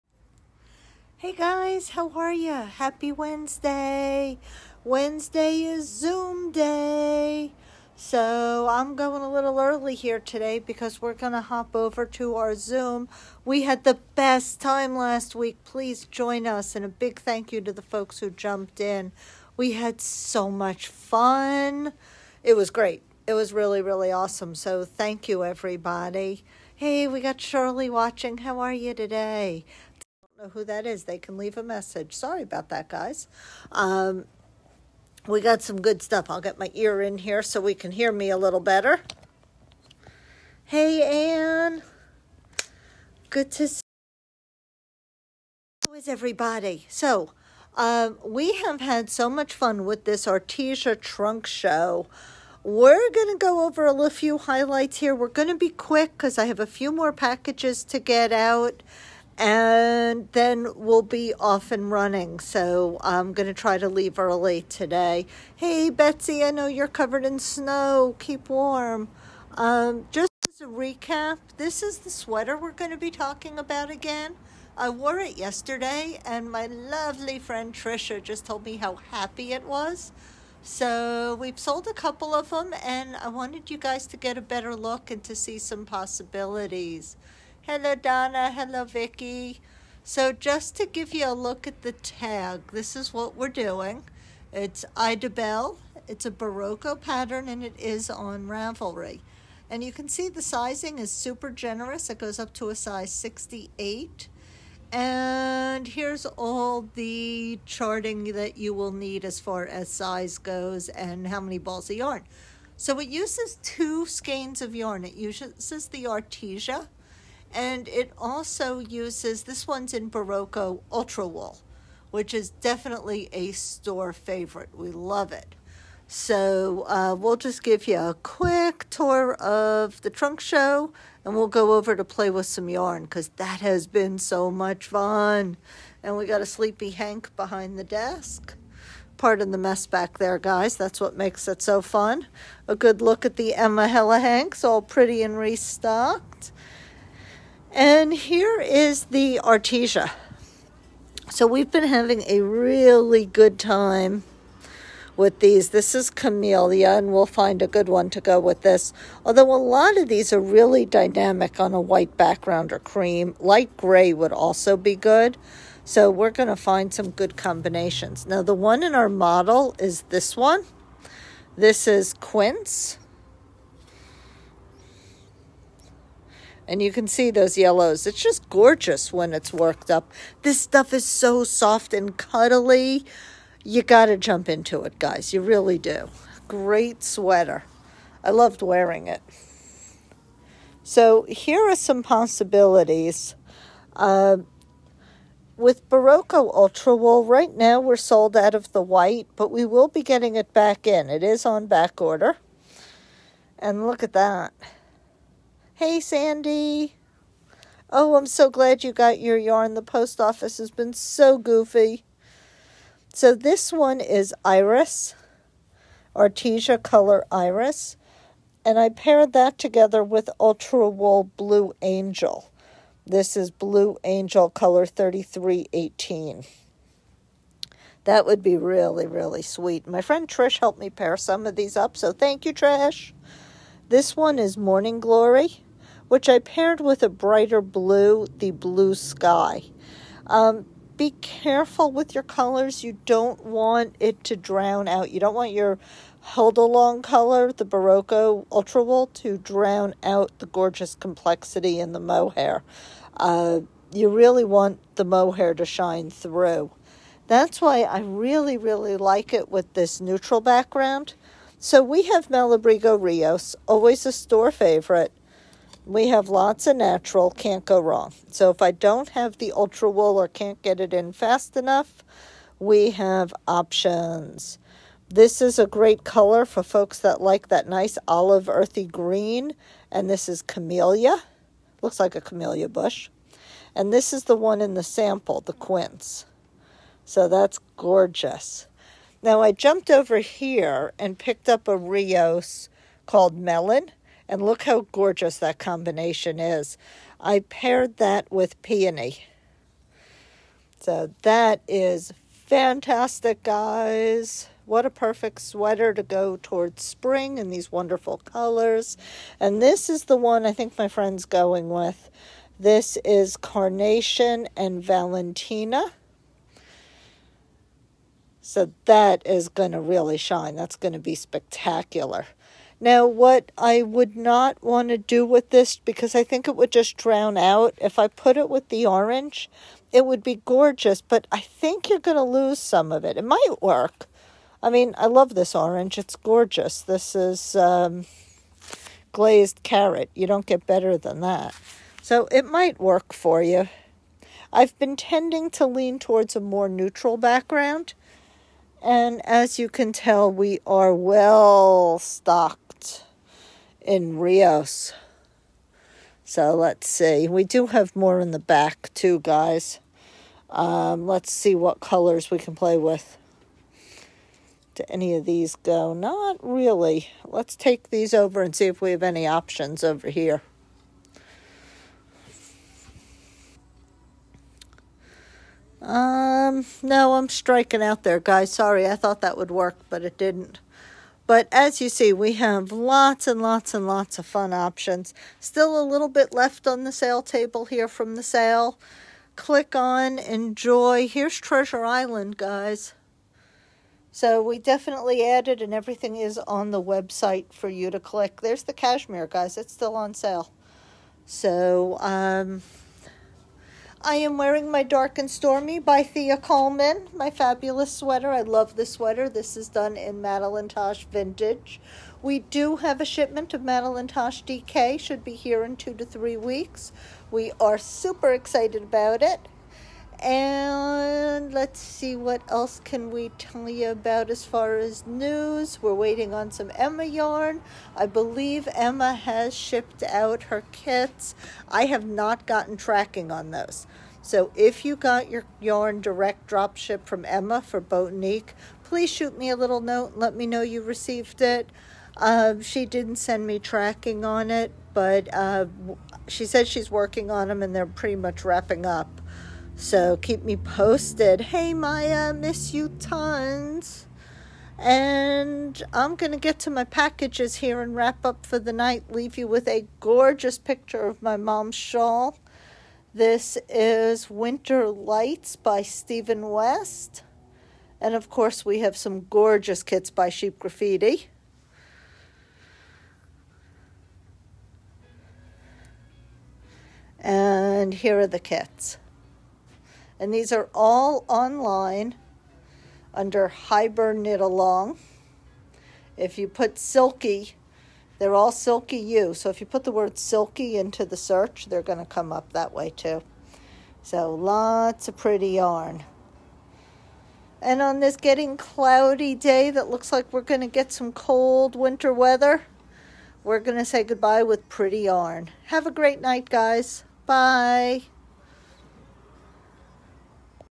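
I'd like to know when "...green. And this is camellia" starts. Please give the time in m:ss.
4:38.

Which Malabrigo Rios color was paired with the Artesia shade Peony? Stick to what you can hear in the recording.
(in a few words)
Melon.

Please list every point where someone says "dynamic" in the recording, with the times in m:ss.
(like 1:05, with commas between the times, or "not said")
2:40.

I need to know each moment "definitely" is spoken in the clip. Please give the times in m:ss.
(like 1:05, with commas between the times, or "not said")
2:02, 6:34.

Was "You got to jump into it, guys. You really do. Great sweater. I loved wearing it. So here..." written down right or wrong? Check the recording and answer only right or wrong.
right.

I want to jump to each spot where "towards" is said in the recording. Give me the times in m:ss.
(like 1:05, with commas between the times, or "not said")
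5:06, 5:45.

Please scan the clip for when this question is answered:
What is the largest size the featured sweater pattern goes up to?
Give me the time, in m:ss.
1:43.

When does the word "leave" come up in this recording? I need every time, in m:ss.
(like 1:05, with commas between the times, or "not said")
0:31, 1:03, 7:39.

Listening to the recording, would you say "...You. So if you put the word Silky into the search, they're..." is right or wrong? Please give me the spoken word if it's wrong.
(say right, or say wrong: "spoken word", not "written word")
right.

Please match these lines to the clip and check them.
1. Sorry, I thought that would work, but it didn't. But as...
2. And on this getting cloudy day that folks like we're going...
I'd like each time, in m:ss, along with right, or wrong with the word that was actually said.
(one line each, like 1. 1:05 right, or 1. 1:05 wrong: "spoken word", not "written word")
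1. 6:18 right
2. 8:17 wrong: "looks", not "folks".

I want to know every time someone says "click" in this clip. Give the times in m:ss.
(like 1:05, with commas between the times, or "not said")
6:29, 6:37.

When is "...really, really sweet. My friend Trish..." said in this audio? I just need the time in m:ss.
3:48.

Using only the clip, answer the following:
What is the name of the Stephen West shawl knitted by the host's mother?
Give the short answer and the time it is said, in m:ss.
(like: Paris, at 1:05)
Winter Lights, at 7:44.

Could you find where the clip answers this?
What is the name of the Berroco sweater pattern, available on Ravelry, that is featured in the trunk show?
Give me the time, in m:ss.
1:34.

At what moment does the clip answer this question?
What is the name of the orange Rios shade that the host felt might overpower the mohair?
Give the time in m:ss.
5:39.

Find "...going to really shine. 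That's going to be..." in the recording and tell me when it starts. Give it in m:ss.
5:19.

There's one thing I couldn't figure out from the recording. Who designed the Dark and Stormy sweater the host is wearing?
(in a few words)
Thea Coleman.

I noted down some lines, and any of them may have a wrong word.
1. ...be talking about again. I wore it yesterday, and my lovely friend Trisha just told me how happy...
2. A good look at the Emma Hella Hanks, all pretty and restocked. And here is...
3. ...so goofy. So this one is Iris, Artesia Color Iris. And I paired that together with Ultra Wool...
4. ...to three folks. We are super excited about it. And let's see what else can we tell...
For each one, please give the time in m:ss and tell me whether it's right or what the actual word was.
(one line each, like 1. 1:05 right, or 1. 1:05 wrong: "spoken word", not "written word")
1. 1:12 right
2. 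2:22 right
3. 3:30 right
4. 6:55 wrong: "weeks", not "folks".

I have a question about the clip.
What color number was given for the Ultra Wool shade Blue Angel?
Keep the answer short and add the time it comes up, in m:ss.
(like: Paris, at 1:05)
3318, at 3:44.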